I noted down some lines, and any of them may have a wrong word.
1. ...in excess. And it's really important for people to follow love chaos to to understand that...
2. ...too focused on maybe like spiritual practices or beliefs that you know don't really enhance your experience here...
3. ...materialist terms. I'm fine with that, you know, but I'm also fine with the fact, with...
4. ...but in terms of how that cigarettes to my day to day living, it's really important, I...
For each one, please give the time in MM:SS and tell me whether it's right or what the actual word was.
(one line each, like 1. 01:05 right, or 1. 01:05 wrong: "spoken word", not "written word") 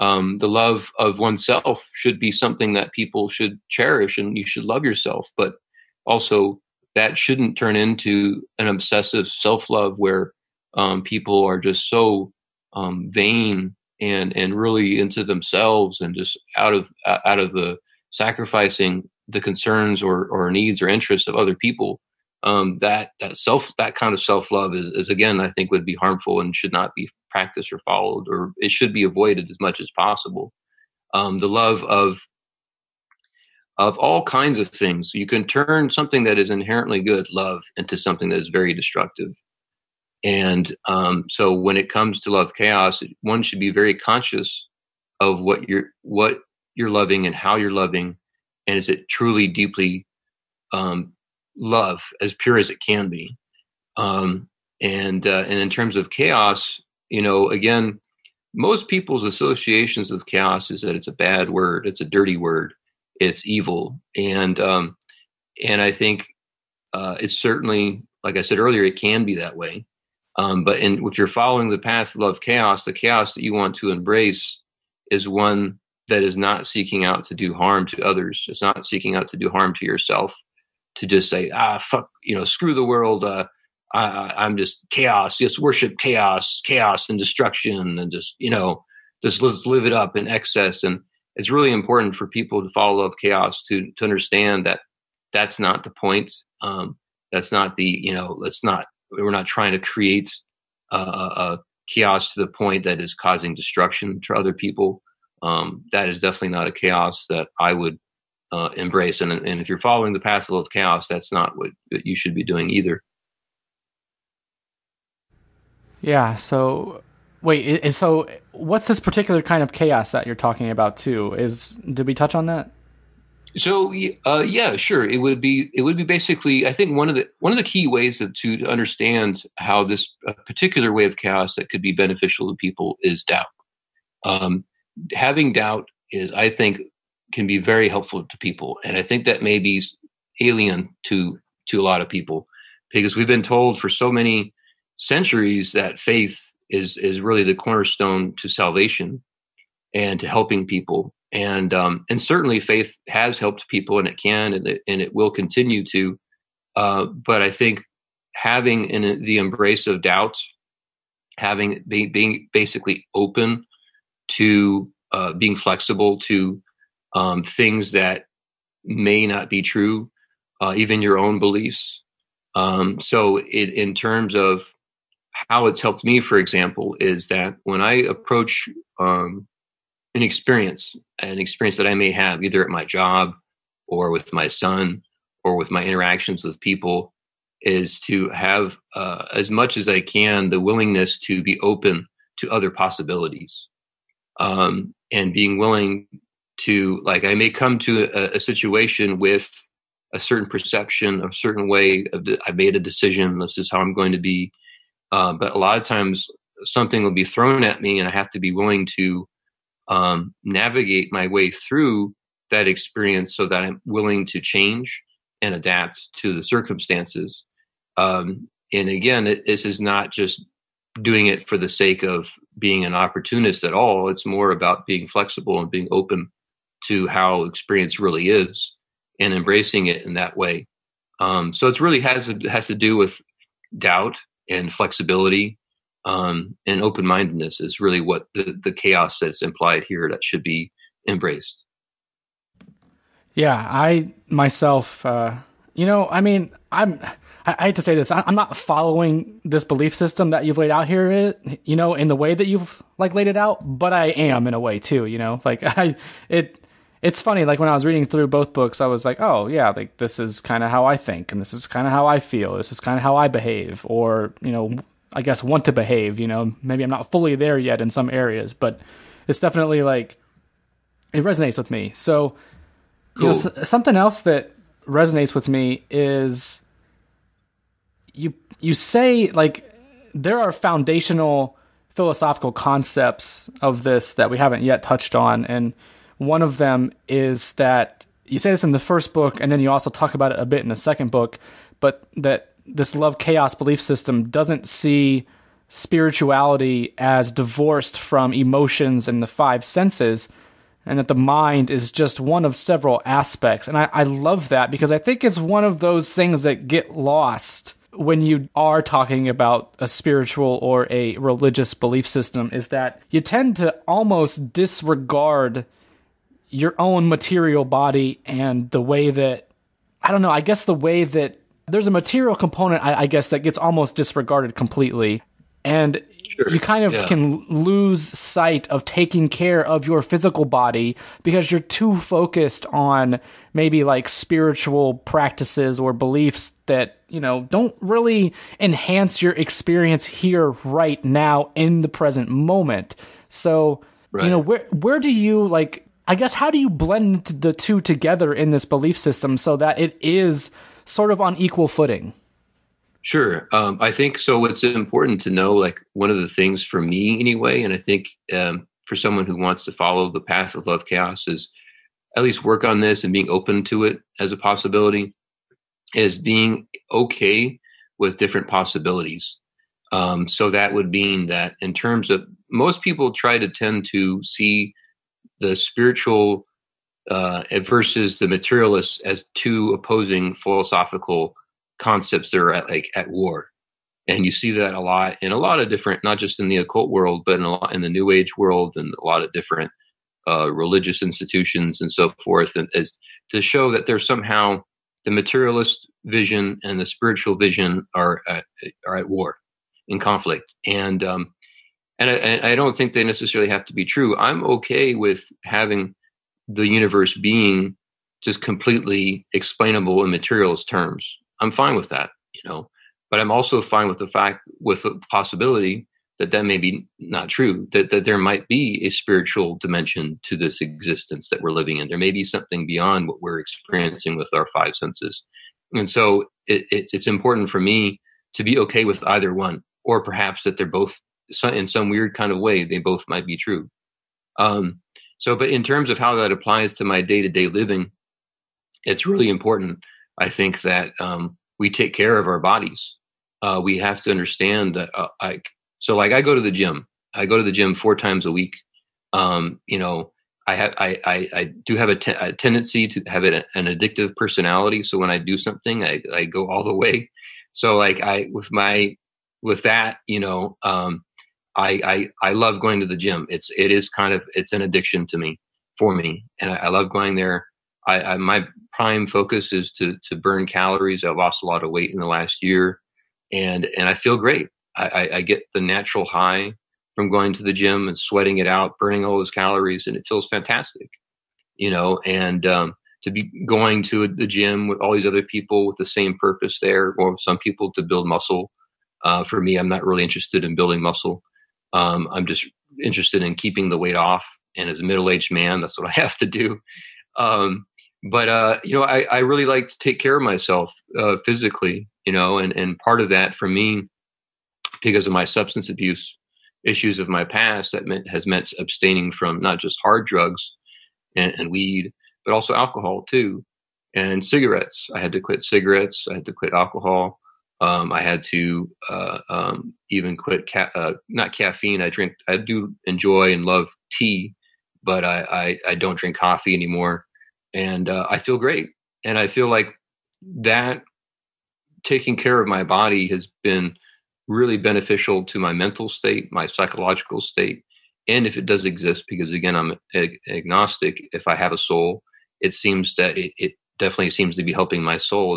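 1. 01:30 right
2. 05:31 right
3. 06:50 right
4. 07:15 wrong: "applies", not "cigarettes".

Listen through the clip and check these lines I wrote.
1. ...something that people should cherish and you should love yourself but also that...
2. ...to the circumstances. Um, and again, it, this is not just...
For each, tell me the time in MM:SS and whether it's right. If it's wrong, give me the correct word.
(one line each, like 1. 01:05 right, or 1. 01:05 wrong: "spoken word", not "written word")
1. 00:02 right
2. 03:36 right.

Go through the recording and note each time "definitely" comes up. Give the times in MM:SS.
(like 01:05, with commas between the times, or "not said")
01:46, 04:29, 09:03.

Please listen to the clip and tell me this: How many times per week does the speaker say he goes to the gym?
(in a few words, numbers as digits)
4.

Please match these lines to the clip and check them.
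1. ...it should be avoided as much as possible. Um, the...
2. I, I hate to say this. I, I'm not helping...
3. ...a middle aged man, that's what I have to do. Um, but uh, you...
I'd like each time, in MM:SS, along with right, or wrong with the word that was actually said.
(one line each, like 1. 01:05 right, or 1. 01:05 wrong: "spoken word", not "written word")
1. 00:28 right
2. 04:07 wrong: "following", not "helping"
3. 08:14 right.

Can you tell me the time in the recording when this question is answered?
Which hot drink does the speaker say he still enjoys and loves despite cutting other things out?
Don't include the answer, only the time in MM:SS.
08:43.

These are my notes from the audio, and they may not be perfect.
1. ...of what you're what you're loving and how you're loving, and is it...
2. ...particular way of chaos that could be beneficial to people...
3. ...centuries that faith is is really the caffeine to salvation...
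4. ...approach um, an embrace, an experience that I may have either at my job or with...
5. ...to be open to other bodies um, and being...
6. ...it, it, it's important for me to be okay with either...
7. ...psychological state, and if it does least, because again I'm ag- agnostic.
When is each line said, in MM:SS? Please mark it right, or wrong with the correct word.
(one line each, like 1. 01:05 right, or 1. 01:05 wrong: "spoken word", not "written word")
1. 00:45 right
2. 02:10 right
3. 02:24 wrong: "cornerstone", not "caffeine"
4. 02:57 wrong: "experience", not "embrace"
5. 03:11 wrong: "possibilities", not "bodies"
6. 07:06 right
7. 08:56 wrong: "exist", not "least".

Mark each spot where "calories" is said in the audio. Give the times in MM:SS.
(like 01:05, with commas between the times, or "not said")
07:50, 07:59.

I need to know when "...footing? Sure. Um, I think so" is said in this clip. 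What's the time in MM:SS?
05:51.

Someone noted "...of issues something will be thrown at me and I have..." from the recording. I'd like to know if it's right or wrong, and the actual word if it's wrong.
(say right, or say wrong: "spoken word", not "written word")
wrong: "times", not "issues".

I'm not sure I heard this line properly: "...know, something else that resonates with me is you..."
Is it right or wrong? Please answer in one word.
right.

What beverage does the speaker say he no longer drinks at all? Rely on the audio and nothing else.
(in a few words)
Coffee.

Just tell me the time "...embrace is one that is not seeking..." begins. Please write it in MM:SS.
01:13.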